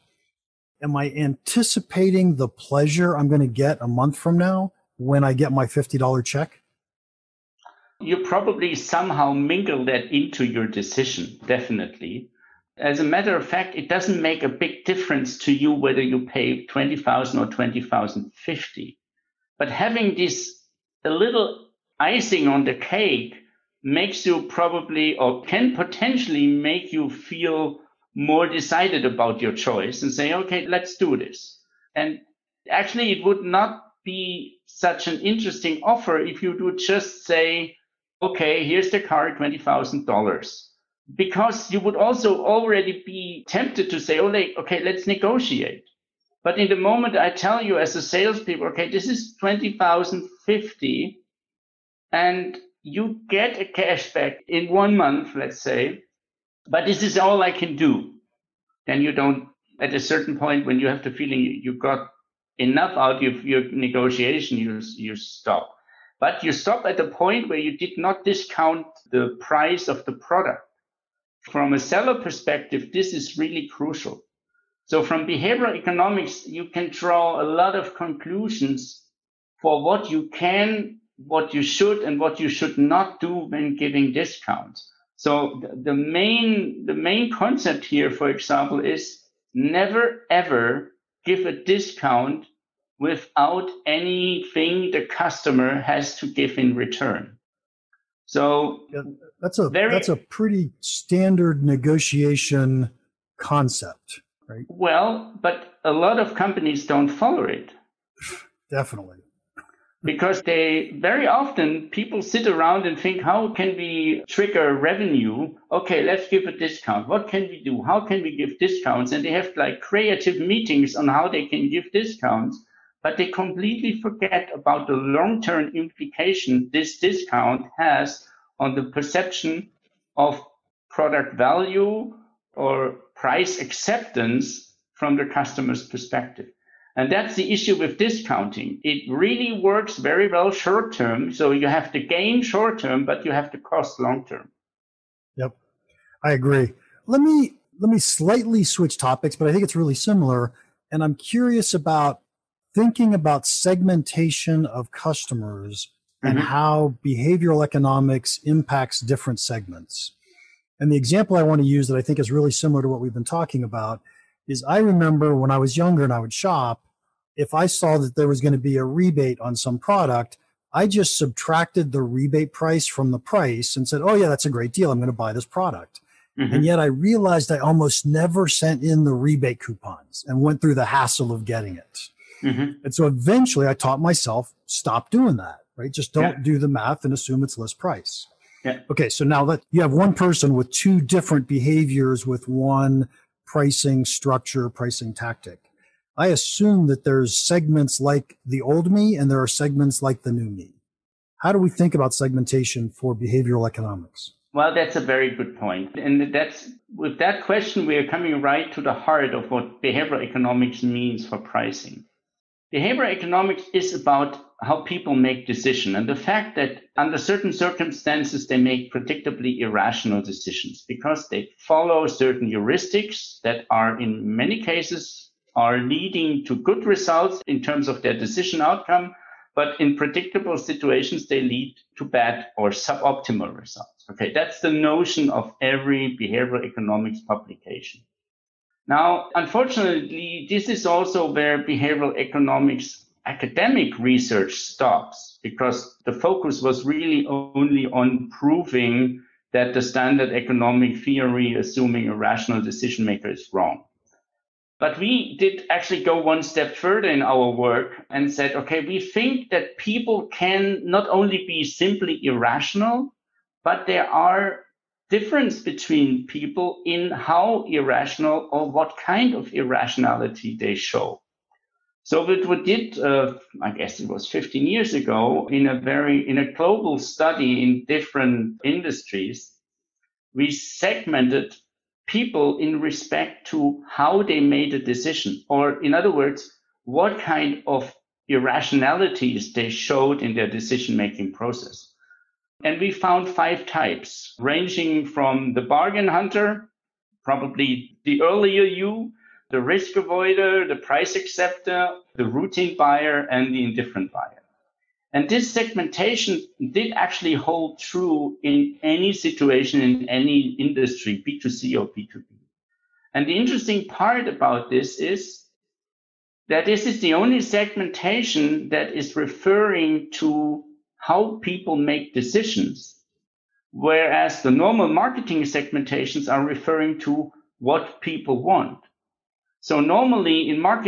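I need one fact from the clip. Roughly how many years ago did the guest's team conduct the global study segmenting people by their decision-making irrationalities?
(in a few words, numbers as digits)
15 years.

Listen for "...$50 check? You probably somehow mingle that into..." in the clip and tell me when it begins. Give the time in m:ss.
0:05.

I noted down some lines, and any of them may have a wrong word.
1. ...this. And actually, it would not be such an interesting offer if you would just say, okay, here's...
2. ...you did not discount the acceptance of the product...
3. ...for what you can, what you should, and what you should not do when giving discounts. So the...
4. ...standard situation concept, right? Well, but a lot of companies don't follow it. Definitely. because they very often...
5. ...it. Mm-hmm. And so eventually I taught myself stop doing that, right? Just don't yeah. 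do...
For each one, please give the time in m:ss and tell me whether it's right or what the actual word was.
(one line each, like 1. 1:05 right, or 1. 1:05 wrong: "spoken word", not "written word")
1. 0:31 right
2. 1:07 wrong: "price", not "acceptance"
3. 1:19 right
4. 1:40 wrong: "negotiation", not "situation"
5. 3:01 right.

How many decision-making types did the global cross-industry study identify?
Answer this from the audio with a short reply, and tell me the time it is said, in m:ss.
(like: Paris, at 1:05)
5, at 4:53.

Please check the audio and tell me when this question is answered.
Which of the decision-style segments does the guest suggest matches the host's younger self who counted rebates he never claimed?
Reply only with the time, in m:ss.
4:55.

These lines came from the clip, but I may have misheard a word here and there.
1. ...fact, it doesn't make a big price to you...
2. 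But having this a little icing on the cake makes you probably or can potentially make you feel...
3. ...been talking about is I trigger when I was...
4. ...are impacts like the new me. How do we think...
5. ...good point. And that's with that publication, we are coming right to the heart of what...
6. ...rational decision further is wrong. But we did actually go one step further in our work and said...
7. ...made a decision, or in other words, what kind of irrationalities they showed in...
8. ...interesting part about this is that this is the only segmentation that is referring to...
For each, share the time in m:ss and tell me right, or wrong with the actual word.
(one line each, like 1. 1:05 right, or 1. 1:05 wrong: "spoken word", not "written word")
1. 0:13 wrong: "difference", not "price"
2. 0:19 right
3. 2:43 wrong: "remember", not "trigger"
4. 3:19 wrong: "segments", not "impacts"
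5. 3:25 wrong: "question", not "publication"
6. 4:12 wrong: "maker", not "further"
7. 4:44 right
8. 5:13 right.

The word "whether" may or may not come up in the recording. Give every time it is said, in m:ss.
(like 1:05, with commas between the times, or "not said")
0:15.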